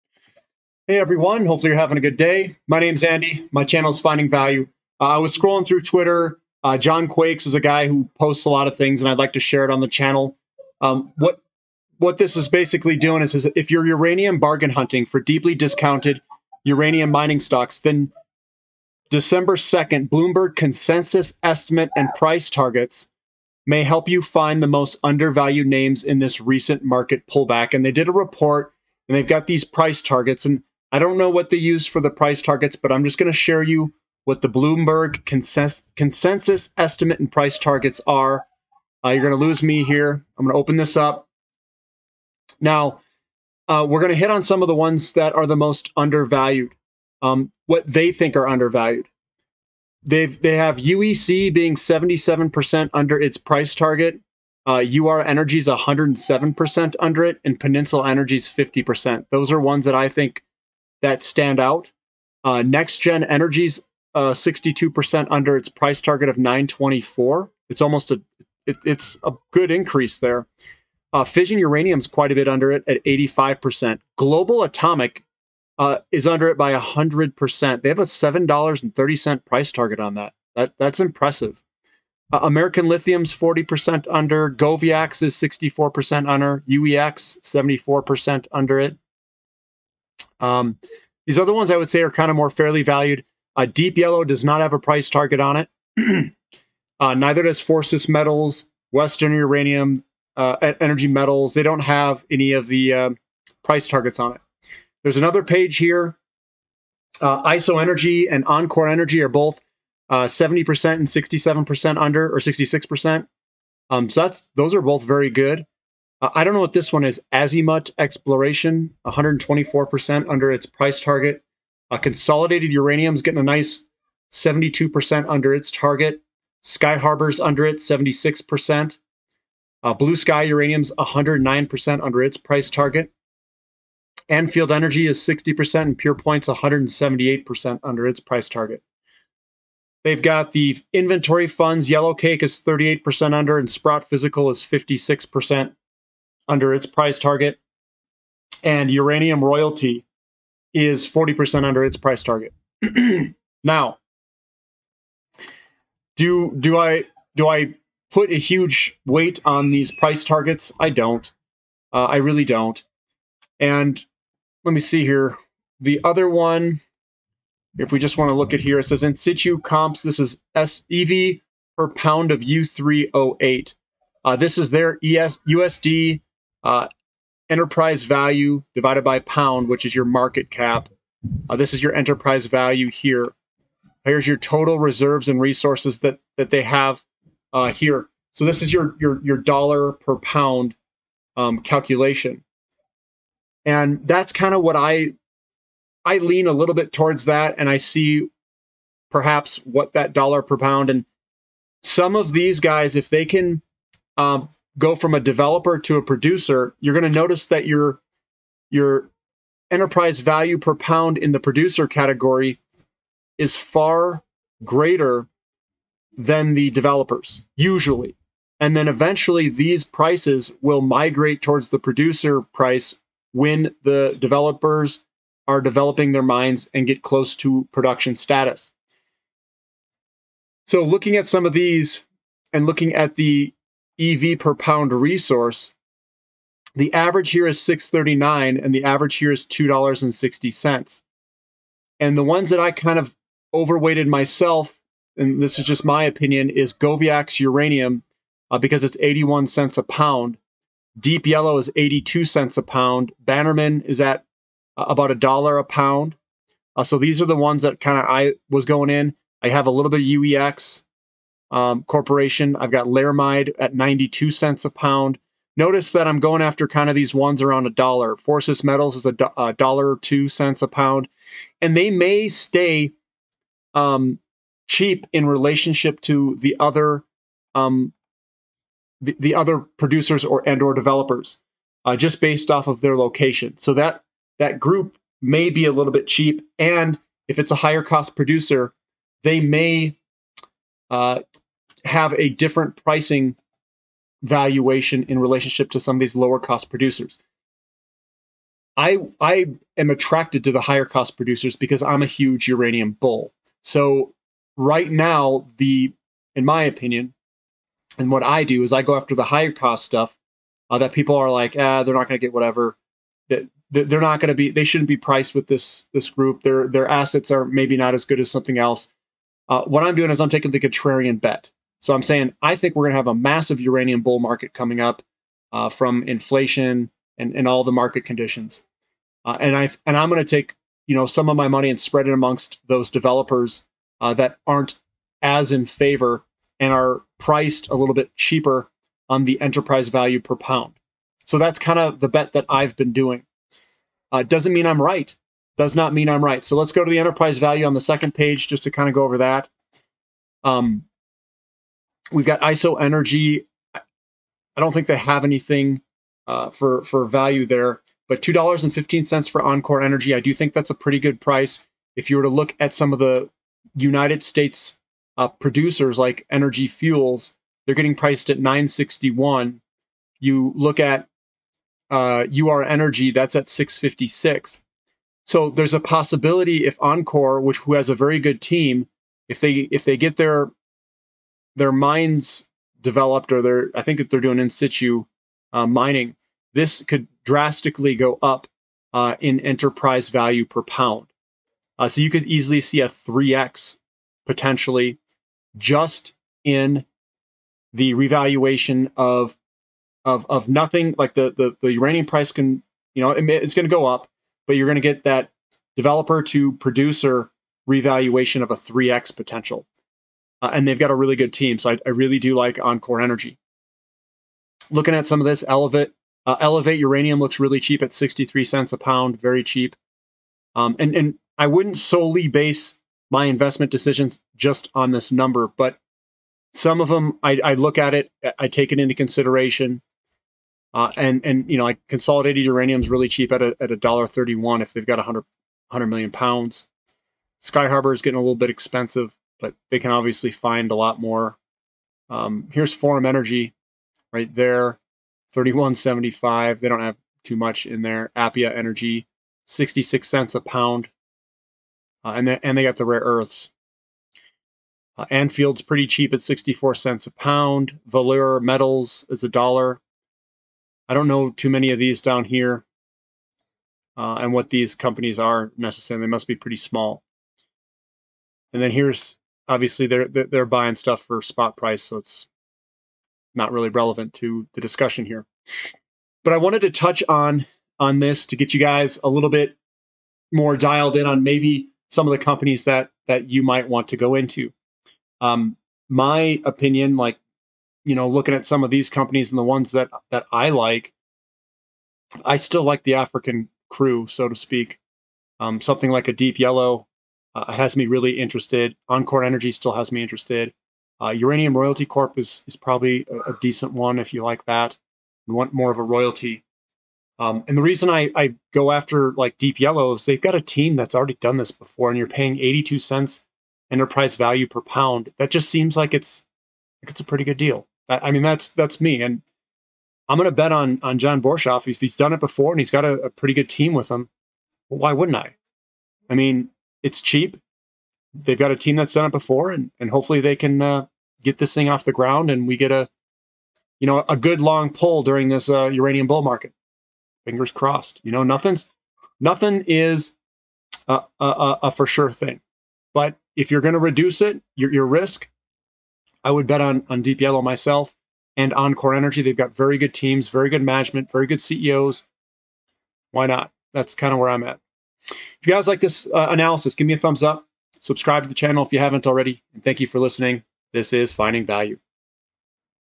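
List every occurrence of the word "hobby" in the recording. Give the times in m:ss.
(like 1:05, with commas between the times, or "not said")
not said.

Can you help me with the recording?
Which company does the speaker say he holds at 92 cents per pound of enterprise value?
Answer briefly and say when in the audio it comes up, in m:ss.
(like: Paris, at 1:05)
Laramide, at 4:22.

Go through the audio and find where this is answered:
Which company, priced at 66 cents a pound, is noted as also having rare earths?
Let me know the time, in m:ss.
7:28.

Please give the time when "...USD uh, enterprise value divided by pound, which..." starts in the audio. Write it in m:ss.
2:55.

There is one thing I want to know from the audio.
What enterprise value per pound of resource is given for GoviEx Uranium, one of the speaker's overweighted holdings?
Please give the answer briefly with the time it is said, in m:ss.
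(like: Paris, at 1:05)
81 cents, at 4:08.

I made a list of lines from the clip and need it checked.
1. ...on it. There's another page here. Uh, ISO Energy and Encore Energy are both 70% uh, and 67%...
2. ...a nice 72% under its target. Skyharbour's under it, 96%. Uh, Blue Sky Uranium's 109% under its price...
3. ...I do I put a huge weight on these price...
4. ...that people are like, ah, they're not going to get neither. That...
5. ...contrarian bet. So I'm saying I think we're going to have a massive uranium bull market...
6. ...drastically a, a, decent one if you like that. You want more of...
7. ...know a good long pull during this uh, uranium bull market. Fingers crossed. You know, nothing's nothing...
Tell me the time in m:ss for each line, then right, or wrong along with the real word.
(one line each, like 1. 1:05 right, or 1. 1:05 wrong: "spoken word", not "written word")
1. 1:44 right
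2. 2:03 wrong: "76", not "96"
3. 2:36 right
4. 5:10 wrong: "whatever", not "neither"
5. 5:20 right
6. 8:22 wrong: "probably", not "drastically"
7. 8:53 right.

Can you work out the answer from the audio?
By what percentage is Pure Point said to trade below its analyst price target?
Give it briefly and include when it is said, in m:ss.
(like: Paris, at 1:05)
178%, at 2:16.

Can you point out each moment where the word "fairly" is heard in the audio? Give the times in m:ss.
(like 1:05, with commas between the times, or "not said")
1:32.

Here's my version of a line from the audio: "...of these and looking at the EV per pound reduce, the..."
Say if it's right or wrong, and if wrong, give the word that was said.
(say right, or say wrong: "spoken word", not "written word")
wrong: "resource", not "reduce".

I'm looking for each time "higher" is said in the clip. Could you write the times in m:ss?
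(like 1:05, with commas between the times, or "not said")
4:47, 5:00, 5:09.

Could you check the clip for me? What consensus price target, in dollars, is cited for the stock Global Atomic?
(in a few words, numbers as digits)
$7.30.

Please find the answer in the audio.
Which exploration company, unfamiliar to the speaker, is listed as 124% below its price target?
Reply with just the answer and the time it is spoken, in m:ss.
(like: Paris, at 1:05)
Azimut Exploration, at 1:57.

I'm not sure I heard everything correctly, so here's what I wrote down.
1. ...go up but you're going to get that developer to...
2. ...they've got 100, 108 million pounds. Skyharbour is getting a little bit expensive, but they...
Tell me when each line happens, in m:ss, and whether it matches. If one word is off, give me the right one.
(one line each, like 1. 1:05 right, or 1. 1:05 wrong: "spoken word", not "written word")
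1. 6:43 right
2. 7:14 wrong: "100", not "108".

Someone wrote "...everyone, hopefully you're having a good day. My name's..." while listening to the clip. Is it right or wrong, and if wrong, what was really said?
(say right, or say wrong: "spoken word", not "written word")
right.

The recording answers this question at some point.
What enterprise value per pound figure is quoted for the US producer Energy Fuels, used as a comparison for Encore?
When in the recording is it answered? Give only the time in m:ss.
6:08.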